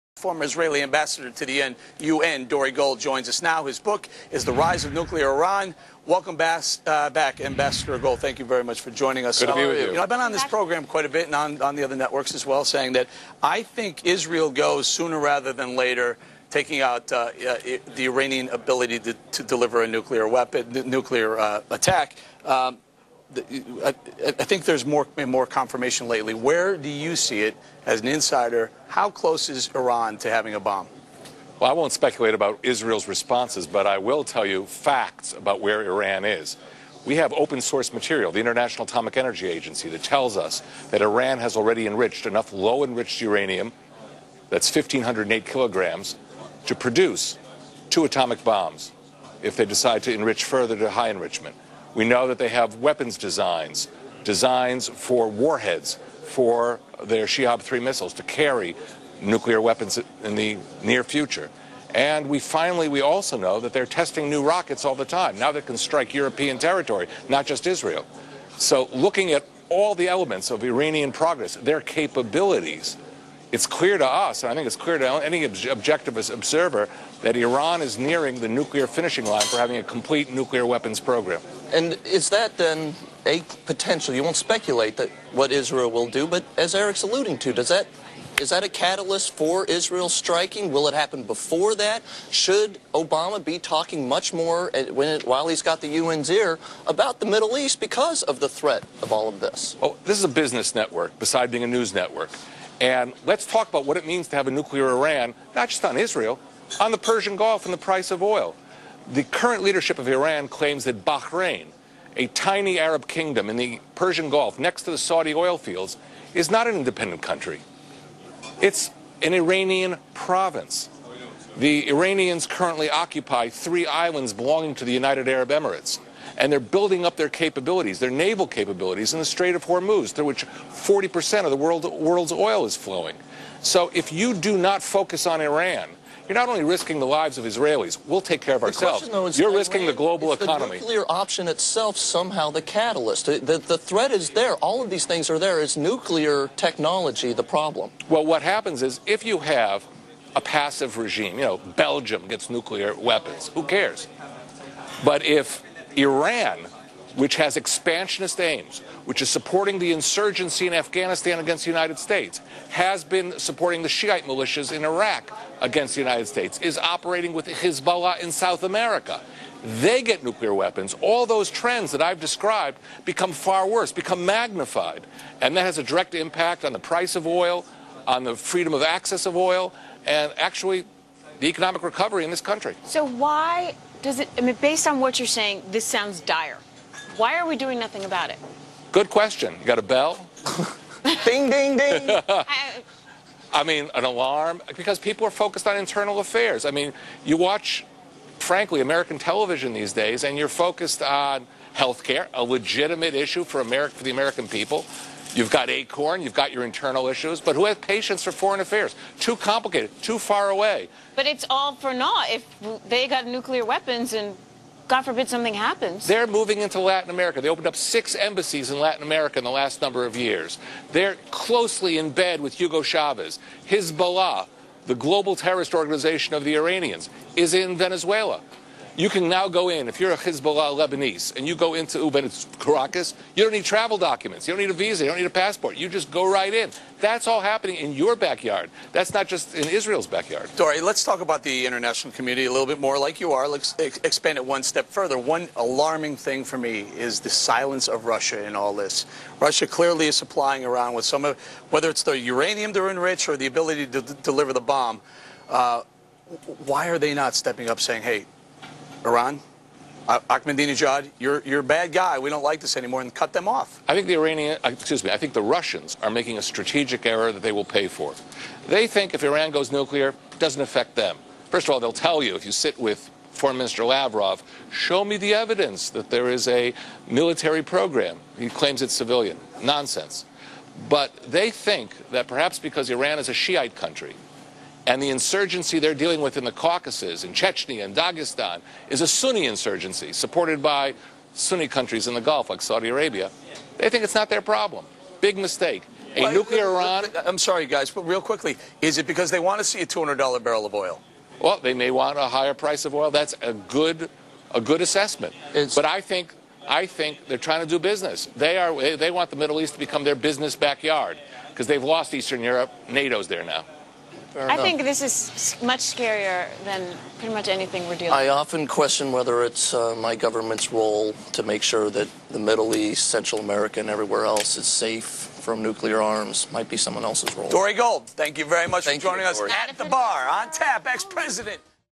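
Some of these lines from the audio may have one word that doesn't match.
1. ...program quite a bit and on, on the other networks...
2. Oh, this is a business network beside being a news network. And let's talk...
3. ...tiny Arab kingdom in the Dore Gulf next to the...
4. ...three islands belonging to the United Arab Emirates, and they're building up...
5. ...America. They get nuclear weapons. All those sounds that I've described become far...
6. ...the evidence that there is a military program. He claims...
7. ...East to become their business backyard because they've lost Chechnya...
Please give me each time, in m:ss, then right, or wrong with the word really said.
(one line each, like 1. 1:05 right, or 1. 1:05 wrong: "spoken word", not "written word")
1. 0:10 right
2. 1:39 right
3. 1:52 wrong: "Persian", not "Dore"
4. 2:03 right
5. 2:48 wrong: "trends", not "sounds"
6. 4:35 right
7. 5:09 wrong: "Eastern", not "Chechnya".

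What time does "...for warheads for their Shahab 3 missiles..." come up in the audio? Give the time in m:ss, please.
0:54.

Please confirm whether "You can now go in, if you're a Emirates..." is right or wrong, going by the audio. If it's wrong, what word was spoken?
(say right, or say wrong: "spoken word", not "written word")
wrong: "Hezbollah", not "Emirates".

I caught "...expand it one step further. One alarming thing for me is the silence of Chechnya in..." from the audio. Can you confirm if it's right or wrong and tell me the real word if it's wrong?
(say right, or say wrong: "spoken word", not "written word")
wrong: "Russia", not "Chechnya".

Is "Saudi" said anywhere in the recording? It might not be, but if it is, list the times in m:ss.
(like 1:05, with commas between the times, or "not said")
1:54, 4:52.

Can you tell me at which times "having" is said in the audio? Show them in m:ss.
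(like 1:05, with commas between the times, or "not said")
0:30, 1:19.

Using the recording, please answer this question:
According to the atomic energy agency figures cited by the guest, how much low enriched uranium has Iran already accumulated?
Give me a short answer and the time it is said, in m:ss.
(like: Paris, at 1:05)
1,508 kilograms, at 0:44.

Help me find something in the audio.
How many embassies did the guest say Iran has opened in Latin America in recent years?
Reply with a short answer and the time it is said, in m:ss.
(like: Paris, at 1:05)
6, at 3:37.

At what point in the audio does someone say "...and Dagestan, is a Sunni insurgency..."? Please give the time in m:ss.
4:47.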